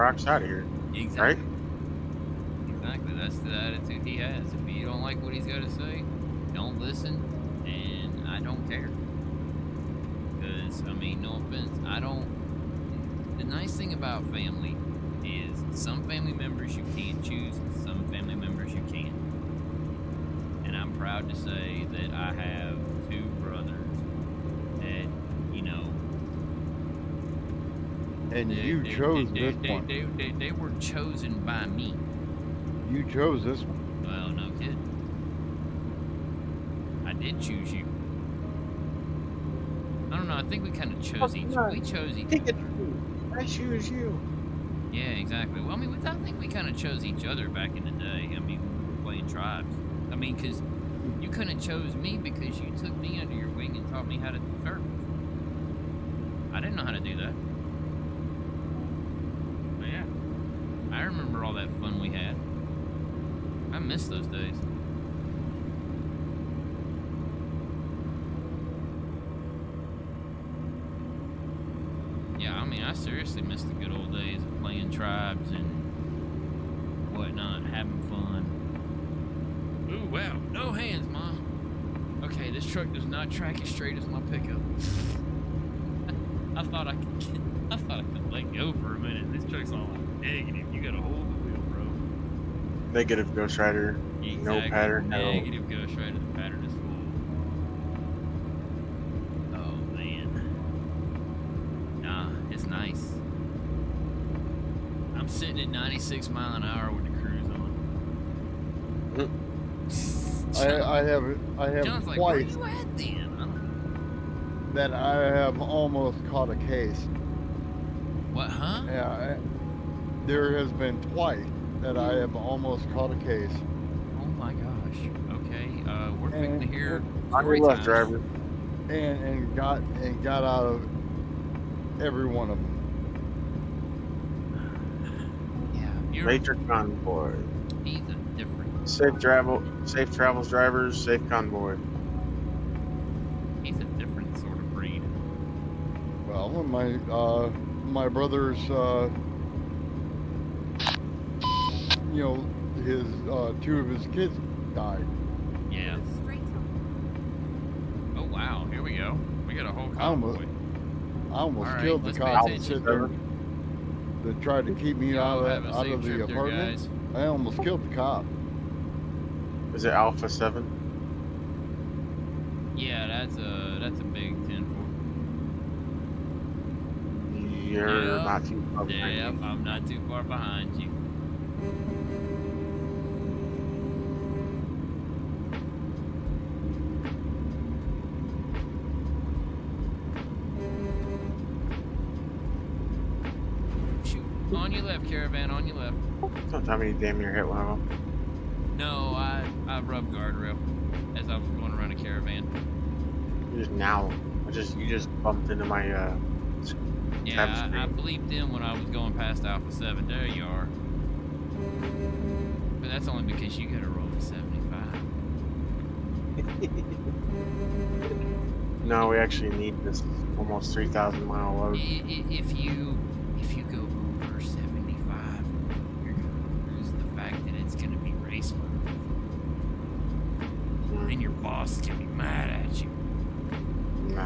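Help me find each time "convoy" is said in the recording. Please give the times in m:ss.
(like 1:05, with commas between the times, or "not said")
2:16, 2:21, 2:39.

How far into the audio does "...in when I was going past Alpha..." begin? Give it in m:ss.
3:28.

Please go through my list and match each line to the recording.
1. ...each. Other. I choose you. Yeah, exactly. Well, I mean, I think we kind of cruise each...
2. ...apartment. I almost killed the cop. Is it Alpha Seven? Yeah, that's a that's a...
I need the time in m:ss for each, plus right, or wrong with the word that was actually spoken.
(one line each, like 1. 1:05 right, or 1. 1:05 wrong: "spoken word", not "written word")
1. 0:42 wrong: "chose", not "cruise"
2. 2:46 right.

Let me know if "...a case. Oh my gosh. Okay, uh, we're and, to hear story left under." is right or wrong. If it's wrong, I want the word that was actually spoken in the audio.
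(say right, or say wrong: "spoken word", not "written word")
wrong: "driver", not "under".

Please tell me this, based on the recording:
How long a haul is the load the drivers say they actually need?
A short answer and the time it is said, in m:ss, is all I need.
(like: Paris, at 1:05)
Almost 3,000 miles, at 3:40.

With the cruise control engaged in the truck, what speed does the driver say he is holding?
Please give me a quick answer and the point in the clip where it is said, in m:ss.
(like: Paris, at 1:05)
96 mph, at 1:45.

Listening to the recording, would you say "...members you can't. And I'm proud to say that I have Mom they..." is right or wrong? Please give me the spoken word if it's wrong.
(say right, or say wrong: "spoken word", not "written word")
wrong: "And", not "Mom".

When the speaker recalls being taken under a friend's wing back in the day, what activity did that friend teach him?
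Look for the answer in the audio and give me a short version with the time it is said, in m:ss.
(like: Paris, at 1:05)
Surf, at 0:54.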